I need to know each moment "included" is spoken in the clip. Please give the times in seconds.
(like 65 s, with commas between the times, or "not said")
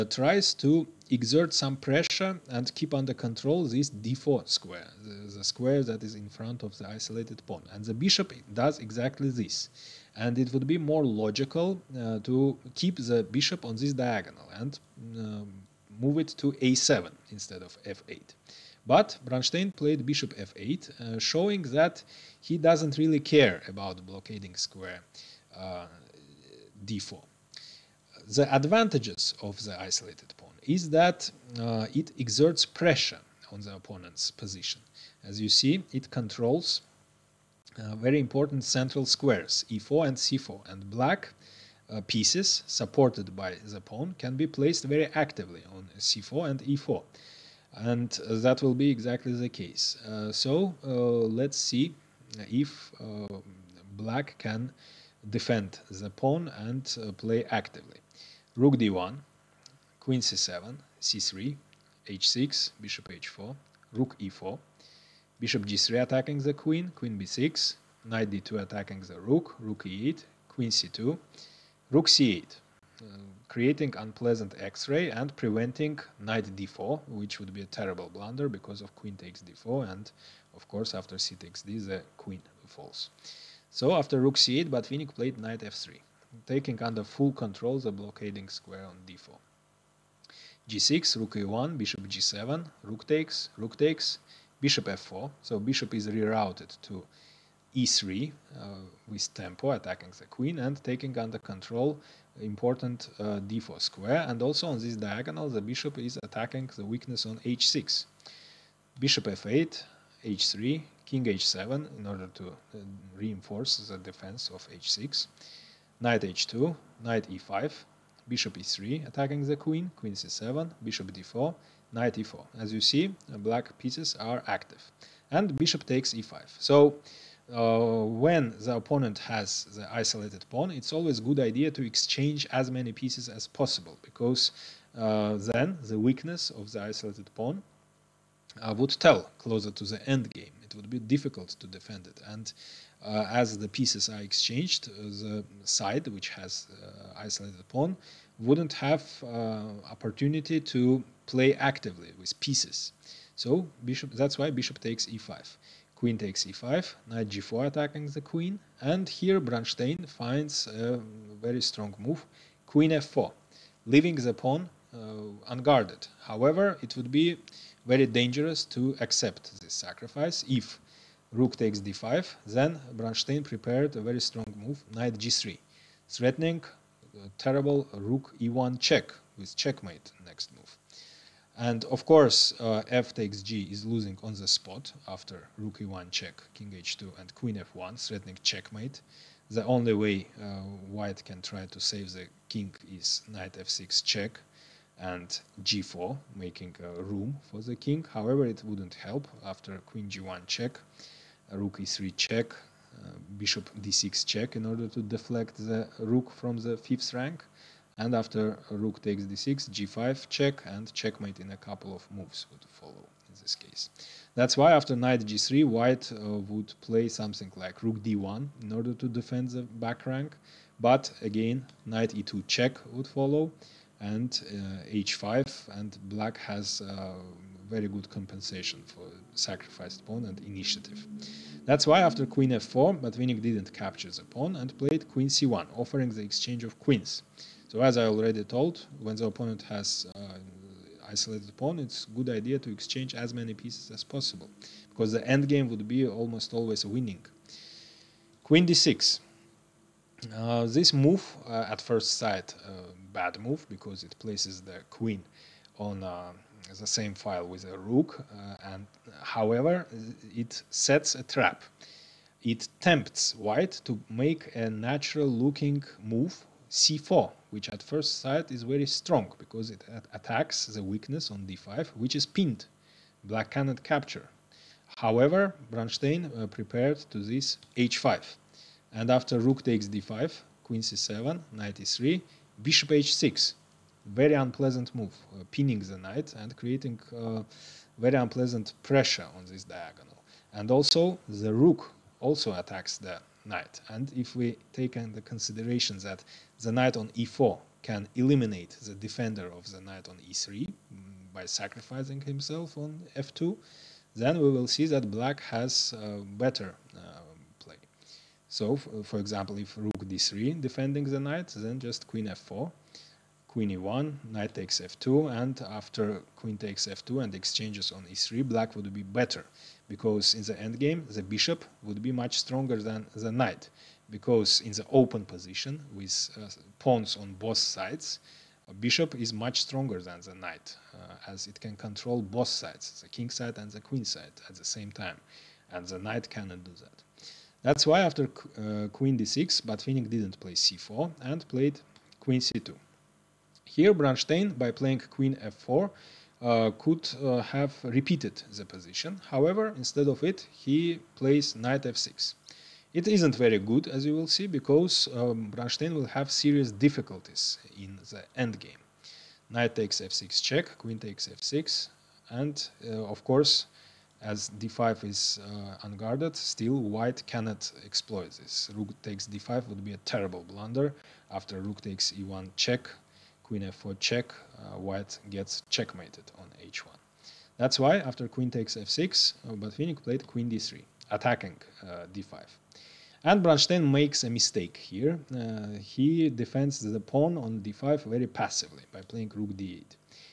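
not said.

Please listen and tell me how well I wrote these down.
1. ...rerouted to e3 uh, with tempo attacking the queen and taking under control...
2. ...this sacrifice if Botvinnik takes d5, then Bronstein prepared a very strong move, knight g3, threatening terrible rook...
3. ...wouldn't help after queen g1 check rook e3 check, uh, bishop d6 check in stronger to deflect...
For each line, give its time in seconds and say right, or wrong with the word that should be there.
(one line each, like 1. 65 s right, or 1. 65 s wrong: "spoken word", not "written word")
1. 96 s right
2. 169 s wrong: "Rook", not "Botvinnik"
3. 198 s wrong: "order", not "stronger".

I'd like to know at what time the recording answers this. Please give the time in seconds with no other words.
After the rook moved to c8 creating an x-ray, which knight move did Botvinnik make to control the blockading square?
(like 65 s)
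85 s.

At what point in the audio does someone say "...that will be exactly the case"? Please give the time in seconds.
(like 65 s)
48 s.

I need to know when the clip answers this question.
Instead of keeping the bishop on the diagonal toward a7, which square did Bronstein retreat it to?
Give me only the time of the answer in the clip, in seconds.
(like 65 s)
18 s.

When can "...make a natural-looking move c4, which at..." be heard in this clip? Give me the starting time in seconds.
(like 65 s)
264 s.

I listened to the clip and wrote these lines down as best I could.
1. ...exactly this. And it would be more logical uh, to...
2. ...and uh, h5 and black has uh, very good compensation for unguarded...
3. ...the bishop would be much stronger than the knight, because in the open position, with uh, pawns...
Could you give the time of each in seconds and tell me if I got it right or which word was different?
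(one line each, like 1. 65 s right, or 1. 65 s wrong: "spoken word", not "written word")
1. 8 s right
2. 223 s wrong: "sacrificed", not "unguarded"
3. 321 s right.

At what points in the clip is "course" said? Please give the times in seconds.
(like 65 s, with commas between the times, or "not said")
80 s, 182 s, 363 s.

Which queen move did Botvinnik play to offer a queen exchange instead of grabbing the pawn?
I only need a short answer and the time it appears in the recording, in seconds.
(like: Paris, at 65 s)
Queen c1, at 235 s.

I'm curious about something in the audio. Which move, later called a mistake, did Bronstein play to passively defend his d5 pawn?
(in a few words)
Rook d8.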